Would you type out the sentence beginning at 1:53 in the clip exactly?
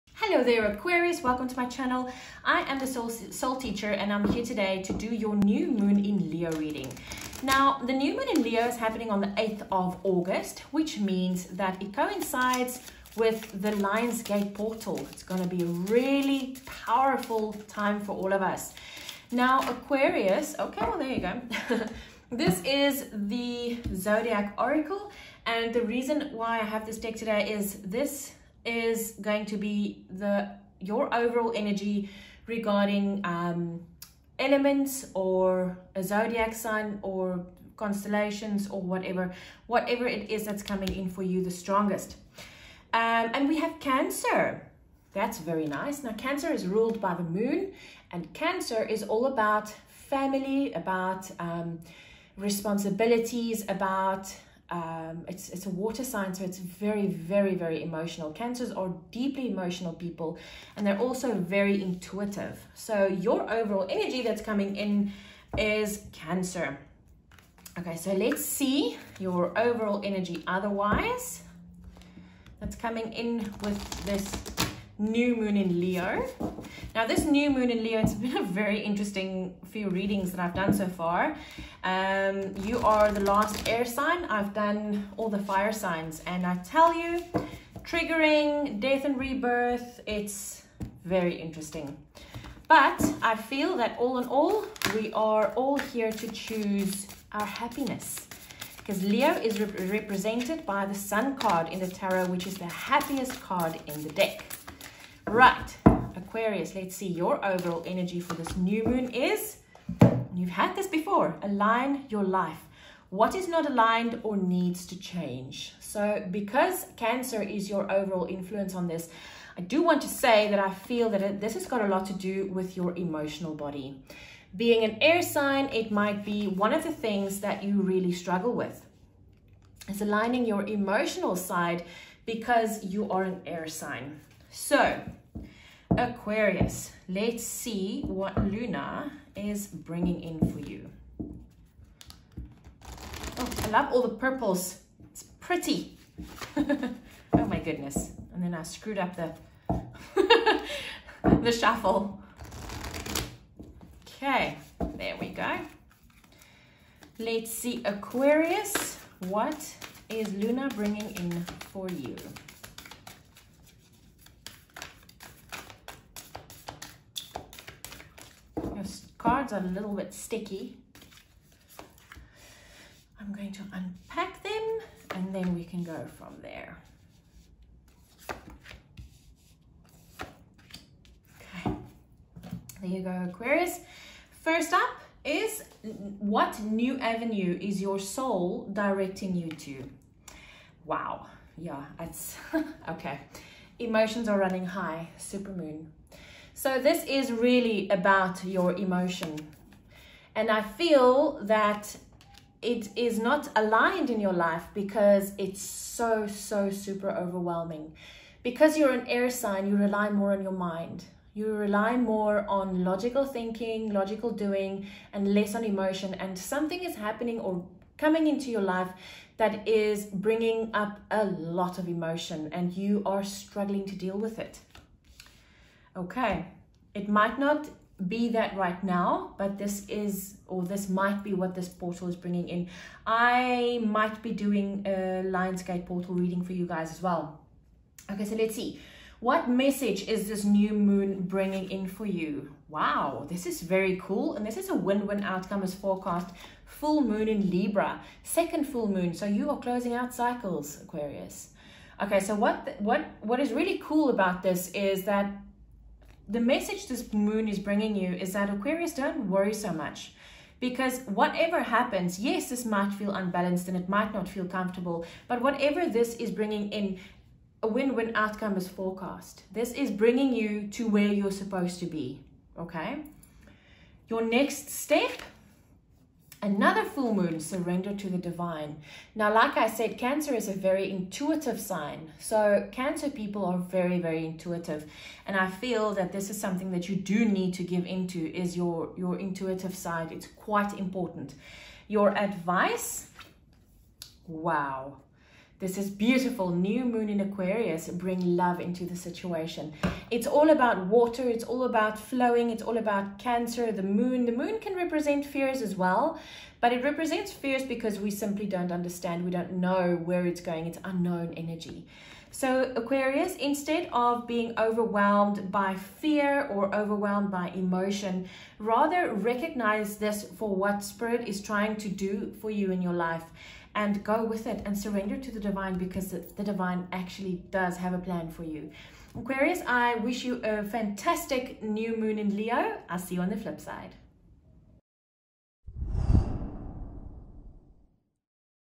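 What is not aligned or needs to change?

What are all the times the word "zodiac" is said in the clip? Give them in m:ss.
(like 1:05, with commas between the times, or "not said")
0:23, 0:36.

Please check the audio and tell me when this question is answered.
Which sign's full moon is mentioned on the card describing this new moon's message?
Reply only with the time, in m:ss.
4:06.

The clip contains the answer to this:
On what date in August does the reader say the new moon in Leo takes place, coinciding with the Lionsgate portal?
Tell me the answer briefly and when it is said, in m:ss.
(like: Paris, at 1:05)
8th of August, at 0:09.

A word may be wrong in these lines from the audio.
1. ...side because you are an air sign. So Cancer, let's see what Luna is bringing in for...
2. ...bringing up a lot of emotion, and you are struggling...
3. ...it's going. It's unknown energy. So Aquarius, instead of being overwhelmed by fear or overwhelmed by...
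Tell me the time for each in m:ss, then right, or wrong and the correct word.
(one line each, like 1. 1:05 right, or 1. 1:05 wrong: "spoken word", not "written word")
1. 2:11 wrong: "Aquarius", not "Cancer"
2. 3:40 right
3. 5:10 right.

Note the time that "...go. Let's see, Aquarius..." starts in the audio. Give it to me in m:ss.
2:35.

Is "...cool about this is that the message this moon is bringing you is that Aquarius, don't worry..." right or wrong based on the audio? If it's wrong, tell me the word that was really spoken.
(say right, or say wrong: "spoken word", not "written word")
right.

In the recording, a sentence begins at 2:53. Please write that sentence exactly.
I'm going to unpack them and then we can go from there.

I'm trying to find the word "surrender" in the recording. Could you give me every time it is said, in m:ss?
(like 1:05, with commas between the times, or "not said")
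4:37, 5:24.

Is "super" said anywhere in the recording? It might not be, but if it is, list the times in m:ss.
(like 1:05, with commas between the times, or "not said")
3:15, 3:26.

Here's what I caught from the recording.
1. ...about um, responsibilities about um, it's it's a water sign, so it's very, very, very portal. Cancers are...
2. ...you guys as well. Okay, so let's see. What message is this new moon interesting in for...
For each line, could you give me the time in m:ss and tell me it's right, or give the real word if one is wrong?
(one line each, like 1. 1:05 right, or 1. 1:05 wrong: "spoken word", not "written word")
1. 0:50 wrong: "emotional", not "portal"
2. 3:56 wrong: "bringing", not "interesting".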